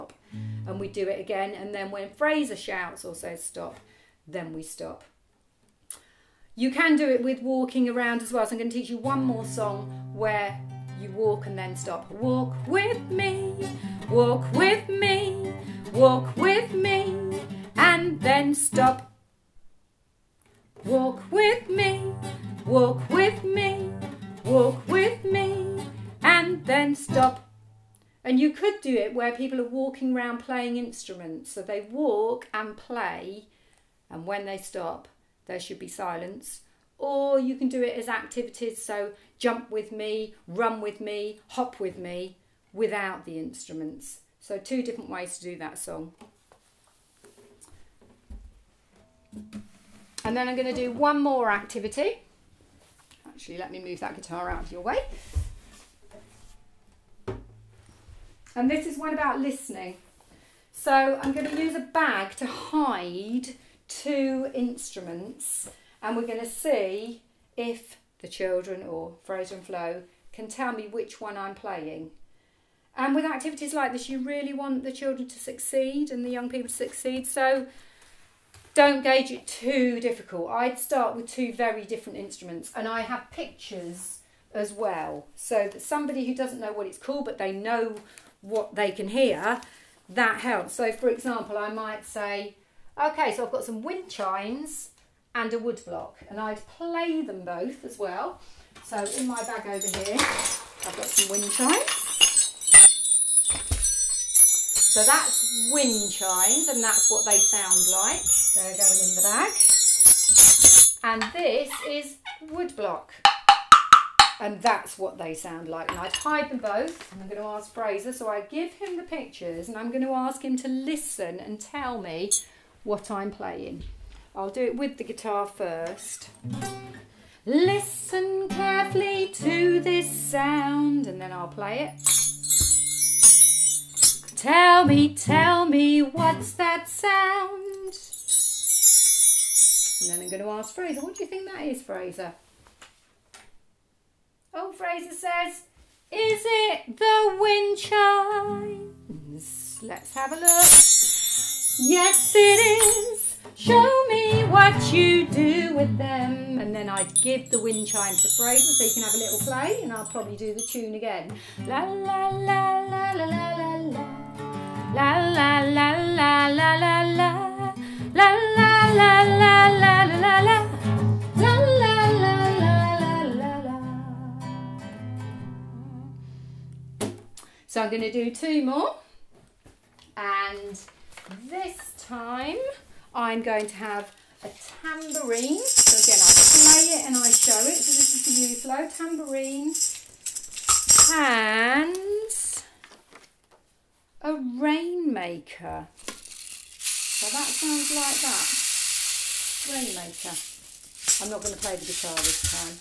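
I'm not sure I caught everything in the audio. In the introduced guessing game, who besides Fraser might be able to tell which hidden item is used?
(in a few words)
Flo.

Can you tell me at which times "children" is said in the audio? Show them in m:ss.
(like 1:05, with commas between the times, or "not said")
1:08, 1:14.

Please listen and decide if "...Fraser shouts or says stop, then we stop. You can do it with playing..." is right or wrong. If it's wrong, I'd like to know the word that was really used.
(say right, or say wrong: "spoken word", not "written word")
wrong: "walking", not "playing".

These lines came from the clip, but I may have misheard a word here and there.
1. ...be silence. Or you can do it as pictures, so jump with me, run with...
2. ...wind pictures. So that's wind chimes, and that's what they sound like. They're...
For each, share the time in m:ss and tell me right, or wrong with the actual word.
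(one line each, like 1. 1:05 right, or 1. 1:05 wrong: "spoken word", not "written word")
1. 0:35 wrong: "activities", not "pictures"
2. 1:41 wrong: "chimes", not "pictures".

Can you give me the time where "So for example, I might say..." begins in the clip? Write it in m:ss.
1:30.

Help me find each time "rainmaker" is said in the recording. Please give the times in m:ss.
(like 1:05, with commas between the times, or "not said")
3:14, 3:19.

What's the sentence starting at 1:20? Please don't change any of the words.
I'd start with two very different instruments, and I have pictures as well.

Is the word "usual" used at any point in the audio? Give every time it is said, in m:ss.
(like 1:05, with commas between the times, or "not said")
3:08.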